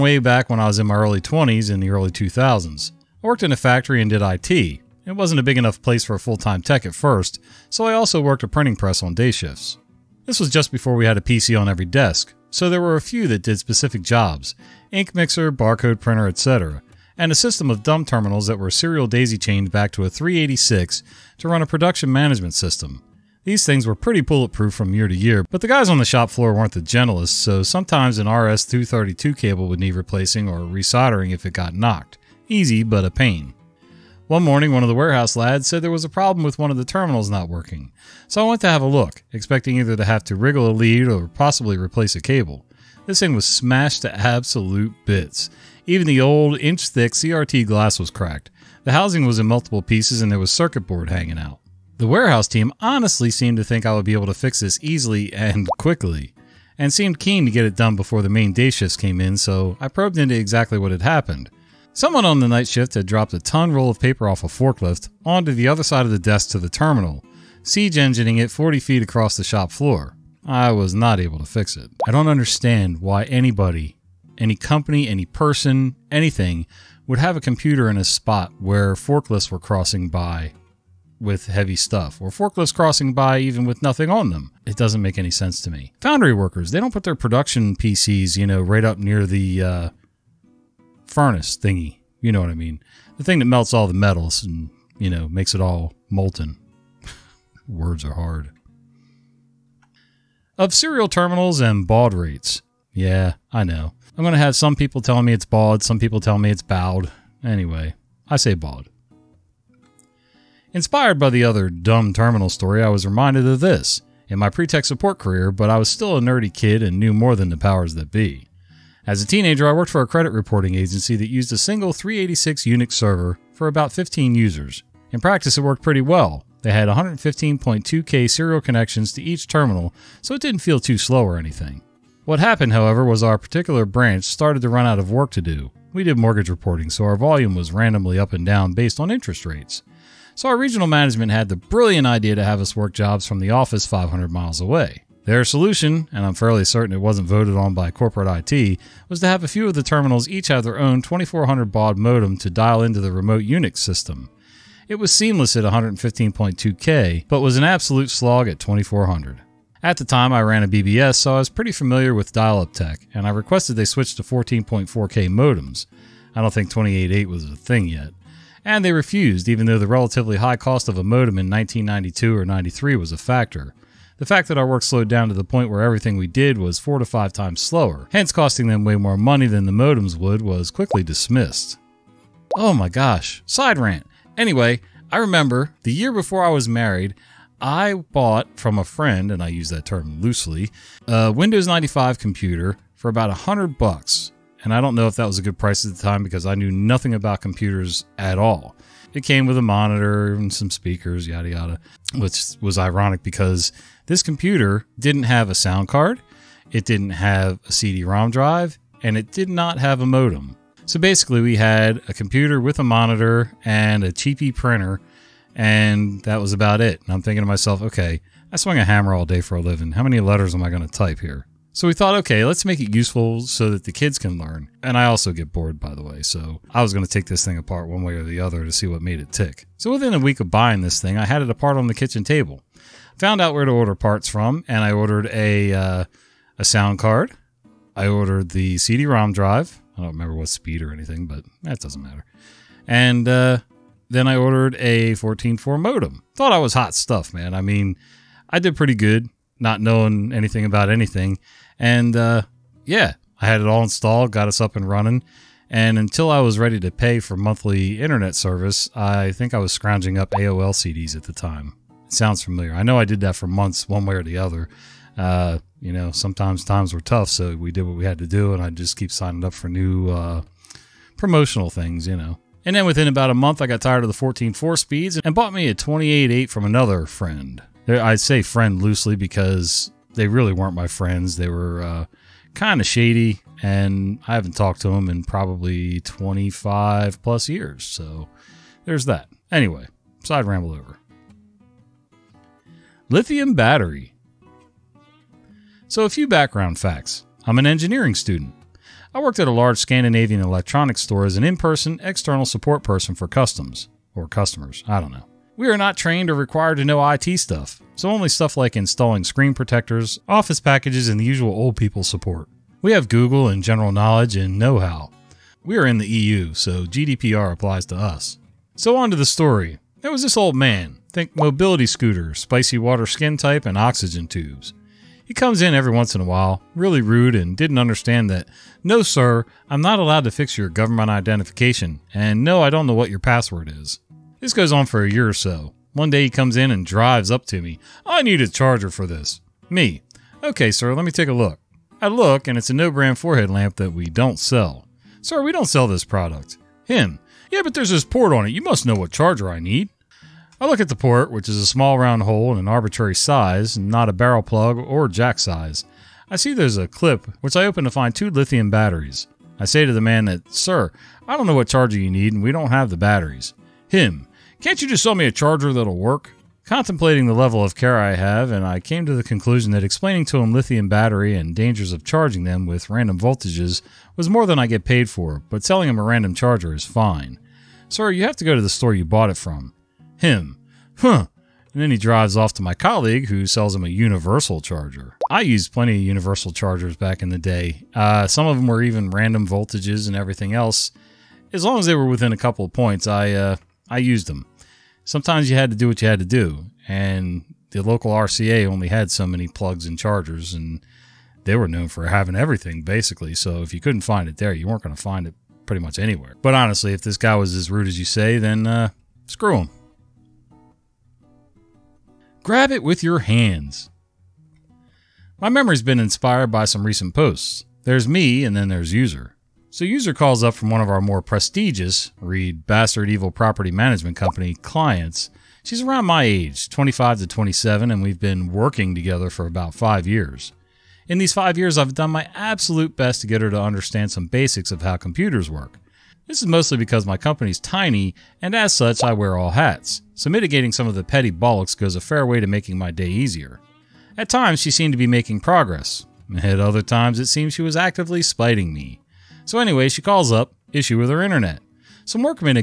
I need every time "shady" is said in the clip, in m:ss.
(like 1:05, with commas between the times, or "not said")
4:42.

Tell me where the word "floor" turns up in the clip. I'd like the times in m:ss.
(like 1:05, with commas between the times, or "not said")
0:26, 1:09.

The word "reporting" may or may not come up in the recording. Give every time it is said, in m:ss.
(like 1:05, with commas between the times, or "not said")
2:00, 2:16.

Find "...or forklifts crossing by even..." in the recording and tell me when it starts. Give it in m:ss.
1:22.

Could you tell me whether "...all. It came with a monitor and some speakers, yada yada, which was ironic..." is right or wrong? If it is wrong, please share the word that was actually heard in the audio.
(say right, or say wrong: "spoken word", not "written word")
right.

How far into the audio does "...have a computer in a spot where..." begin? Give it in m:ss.
1:17.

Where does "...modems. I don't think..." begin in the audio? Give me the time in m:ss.
2:45.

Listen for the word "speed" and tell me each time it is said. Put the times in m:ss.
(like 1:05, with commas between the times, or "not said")
4:00, 4:34.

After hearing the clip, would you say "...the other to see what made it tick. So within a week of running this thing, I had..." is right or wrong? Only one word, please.
wrong.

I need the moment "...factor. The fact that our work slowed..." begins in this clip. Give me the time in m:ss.
2:53.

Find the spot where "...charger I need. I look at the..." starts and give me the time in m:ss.
5:49.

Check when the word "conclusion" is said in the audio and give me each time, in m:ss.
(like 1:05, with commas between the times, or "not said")
6:09.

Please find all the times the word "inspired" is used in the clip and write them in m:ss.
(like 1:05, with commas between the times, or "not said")
1:50, 6:55.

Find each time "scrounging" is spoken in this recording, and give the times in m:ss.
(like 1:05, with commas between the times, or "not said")
4:19.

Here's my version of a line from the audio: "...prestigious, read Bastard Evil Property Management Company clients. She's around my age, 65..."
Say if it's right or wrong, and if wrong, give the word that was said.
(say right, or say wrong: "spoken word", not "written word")
wrong: "25", not "65".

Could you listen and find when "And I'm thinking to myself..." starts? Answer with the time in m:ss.
3:37.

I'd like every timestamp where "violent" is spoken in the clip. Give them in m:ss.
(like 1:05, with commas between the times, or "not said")
not said.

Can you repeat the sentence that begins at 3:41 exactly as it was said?
So we thought, okay, let's make it useful so that the kids can learn.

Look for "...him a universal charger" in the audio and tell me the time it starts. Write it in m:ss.
6:23.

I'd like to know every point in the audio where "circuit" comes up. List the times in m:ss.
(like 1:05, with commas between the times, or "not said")
0:50.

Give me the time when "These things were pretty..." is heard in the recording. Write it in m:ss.
0:23.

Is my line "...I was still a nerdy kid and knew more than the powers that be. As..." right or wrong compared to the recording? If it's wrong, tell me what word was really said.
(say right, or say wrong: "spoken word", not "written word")
right.